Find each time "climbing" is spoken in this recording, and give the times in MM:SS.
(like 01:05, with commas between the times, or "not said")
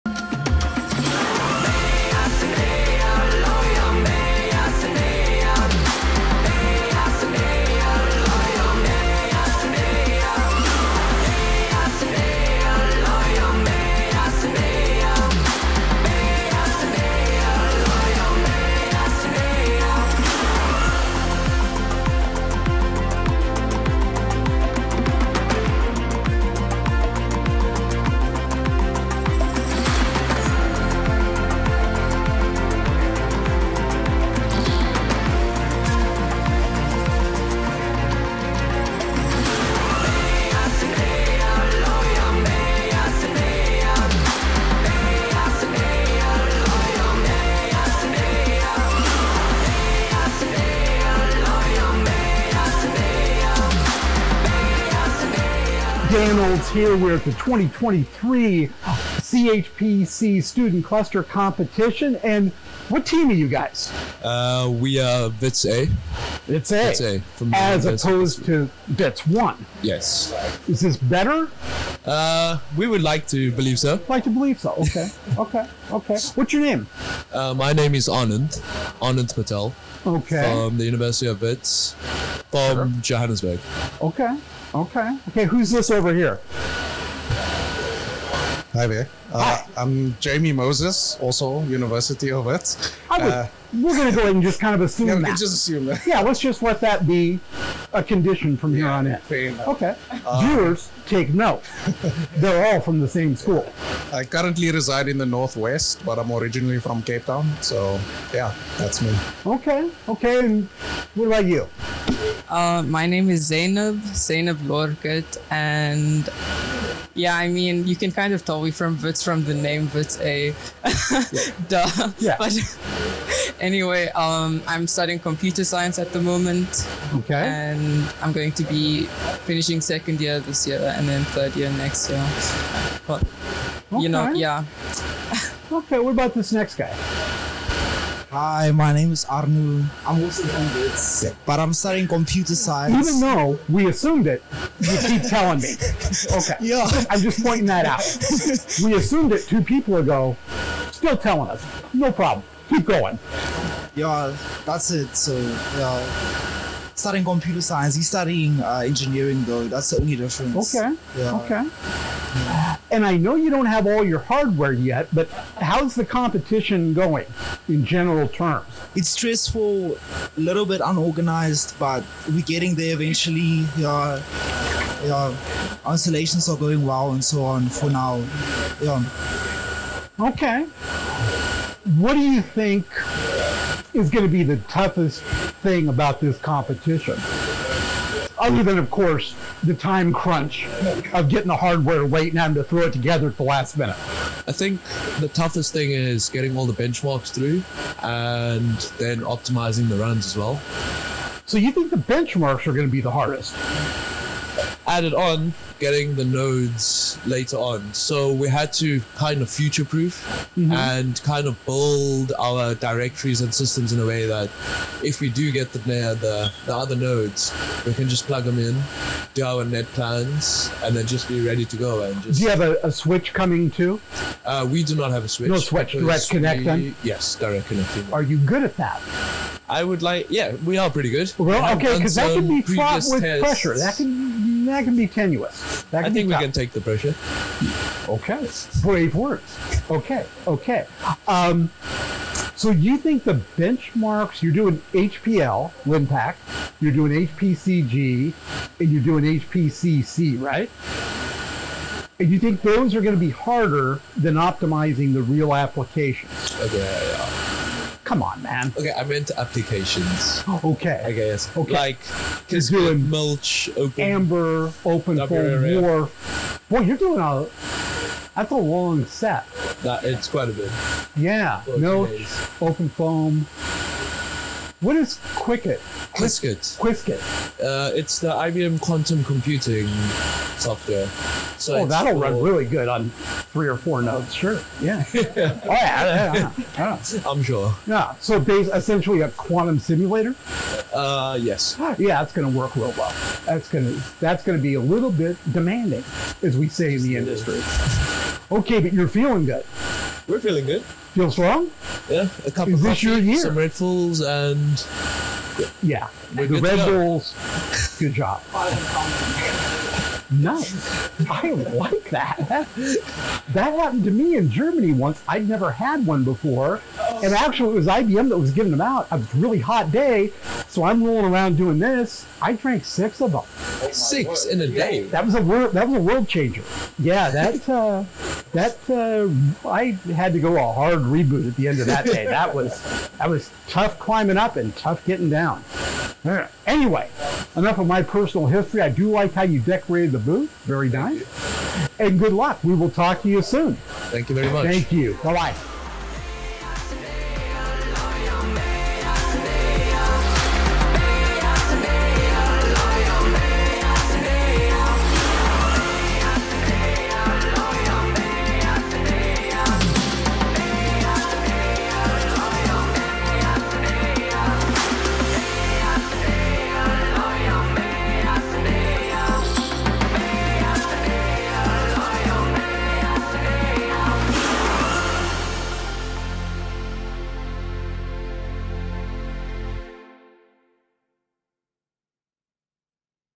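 05:33.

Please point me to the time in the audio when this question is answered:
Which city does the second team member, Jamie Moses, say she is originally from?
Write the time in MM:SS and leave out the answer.
01:47.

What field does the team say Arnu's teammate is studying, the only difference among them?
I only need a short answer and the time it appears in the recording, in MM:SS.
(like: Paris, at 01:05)
Engineering, at 02:38.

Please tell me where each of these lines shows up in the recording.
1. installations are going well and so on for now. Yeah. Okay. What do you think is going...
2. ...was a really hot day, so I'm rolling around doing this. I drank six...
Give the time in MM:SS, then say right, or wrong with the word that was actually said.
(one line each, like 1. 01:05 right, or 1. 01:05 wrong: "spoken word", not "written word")
1. 02:55 right
2. 05:19 right.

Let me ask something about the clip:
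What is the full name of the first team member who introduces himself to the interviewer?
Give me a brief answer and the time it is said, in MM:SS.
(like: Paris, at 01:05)
Anand Patel, at 01:19.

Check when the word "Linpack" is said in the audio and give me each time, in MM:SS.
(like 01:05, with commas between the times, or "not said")
04:05.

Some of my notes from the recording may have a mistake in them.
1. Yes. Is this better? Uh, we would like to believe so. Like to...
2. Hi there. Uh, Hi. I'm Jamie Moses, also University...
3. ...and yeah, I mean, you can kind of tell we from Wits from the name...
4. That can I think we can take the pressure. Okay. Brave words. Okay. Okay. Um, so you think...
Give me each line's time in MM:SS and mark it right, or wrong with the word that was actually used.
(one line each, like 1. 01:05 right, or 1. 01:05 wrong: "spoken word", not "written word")
1. 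01:09 right
2. 01:28 right
3. 01:55 right
4. 03:55 right.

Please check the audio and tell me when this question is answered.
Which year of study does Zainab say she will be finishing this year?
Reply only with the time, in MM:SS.
02:09.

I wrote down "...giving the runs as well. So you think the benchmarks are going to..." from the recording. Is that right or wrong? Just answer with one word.
wrong.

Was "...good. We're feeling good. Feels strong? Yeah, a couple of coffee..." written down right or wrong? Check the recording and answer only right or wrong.
right.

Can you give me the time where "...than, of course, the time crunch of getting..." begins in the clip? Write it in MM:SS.
03:08.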